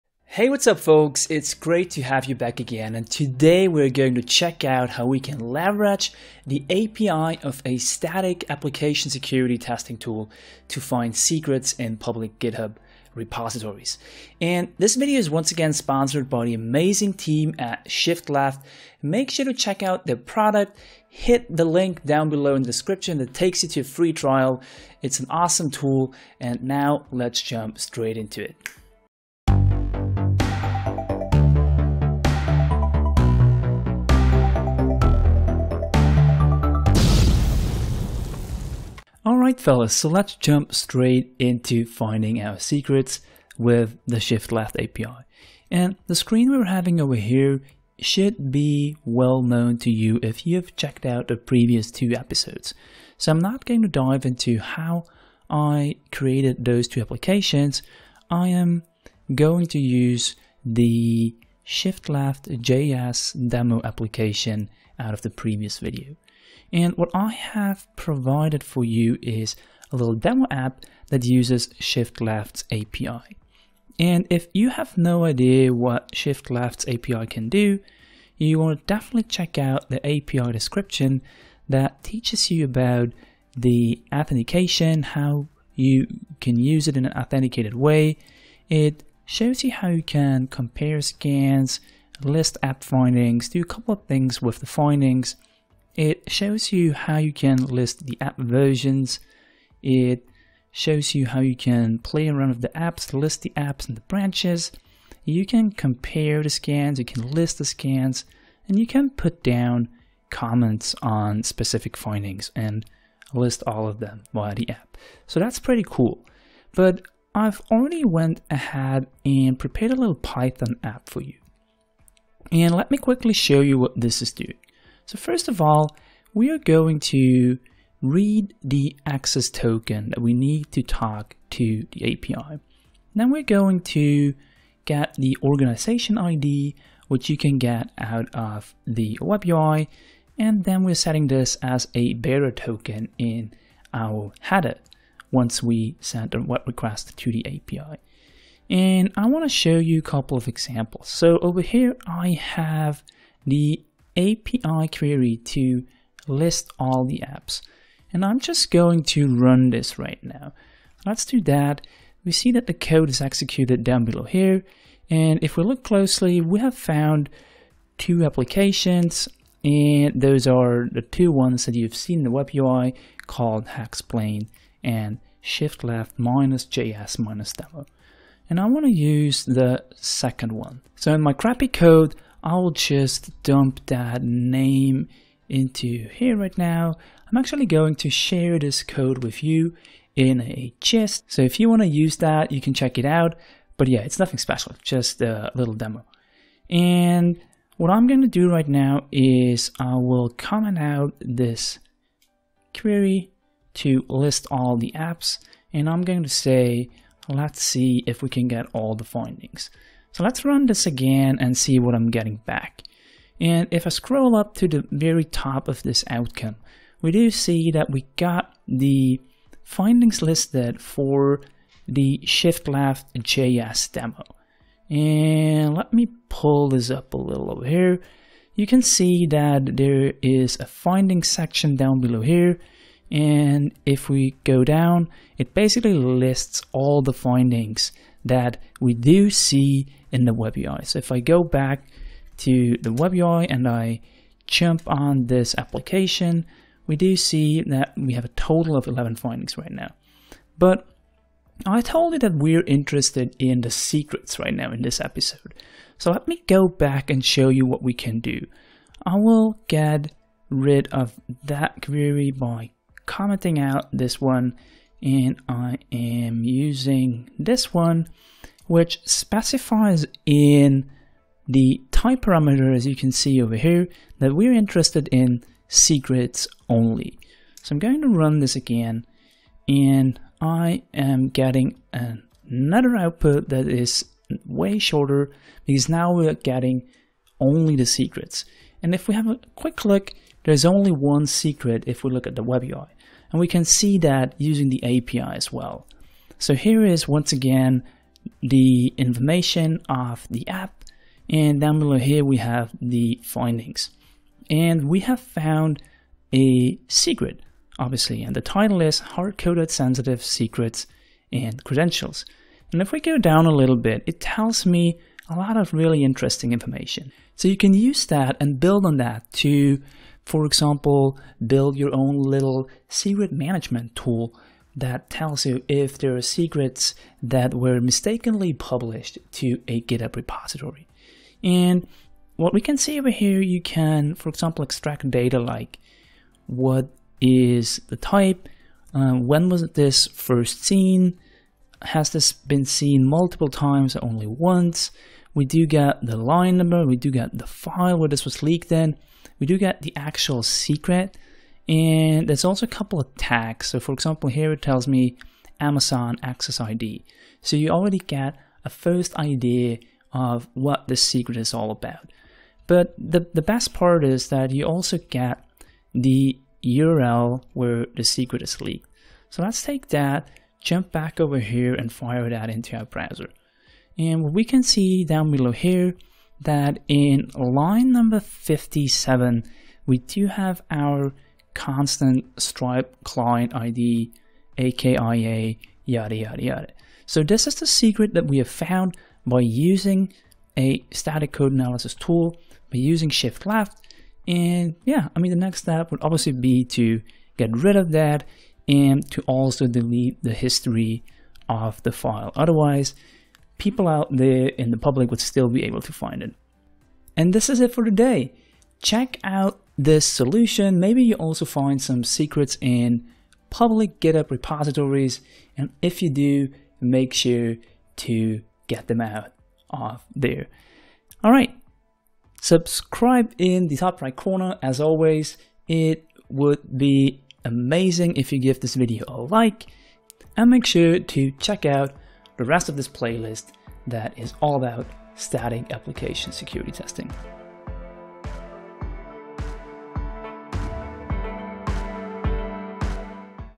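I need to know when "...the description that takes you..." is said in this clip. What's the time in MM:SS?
00:22.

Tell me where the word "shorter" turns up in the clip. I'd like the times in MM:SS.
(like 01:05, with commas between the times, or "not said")
04:44.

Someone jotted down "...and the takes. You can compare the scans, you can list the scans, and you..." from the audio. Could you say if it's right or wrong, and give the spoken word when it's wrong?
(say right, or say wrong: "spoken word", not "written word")
wrong: "branches", not "takes".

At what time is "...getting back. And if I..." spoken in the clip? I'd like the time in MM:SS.
03:32.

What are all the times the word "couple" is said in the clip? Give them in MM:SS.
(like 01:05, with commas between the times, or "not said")
01:33, 02:30, 05:52.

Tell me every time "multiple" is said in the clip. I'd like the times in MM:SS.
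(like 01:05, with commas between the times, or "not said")
05:43.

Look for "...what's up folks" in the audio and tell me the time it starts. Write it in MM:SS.
00:00.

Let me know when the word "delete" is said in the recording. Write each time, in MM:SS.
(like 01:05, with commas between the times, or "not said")
06:39.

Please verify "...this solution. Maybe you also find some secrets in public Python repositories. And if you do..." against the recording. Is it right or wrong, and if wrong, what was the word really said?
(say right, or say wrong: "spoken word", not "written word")
wrong: "GitHub", not "Python".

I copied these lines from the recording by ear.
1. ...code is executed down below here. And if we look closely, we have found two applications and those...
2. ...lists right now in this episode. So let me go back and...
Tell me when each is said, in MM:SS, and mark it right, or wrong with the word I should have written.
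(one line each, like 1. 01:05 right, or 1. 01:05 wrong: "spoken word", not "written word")
1. 02:42 right
2. 04:13 wrong: "secrets", not "lists".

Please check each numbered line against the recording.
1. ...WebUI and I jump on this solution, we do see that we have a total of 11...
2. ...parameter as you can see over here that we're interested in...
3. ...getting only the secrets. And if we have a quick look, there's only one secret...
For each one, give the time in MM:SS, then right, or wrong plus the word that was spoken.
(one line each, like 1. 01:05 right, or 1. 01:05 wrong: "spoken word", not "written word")
1. 04:02 wrong: "application", not "solution"
2. 04:32 right
3. 04:46 right.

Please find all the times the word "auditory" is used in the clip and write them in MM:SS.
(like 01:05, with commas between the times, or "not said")
not said.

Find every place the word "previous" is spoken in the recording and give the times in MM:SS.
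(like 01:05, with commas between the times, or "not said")
00:51, 01:05.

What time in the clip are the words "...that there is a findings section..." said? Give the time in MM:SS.
03:49.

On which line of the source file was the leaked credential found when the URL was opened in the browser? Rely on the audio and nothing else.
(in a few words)
57.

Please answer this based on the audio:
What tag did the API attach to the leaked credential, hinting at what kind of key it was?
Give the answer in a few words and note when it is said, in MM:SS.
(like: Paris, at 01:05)
Amazon access ID, at 05:55.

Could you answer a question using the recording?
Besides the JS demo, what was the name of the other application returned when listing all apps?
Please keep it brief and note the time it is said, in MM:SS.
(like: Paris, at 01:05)
Hacksplained, at 02:53.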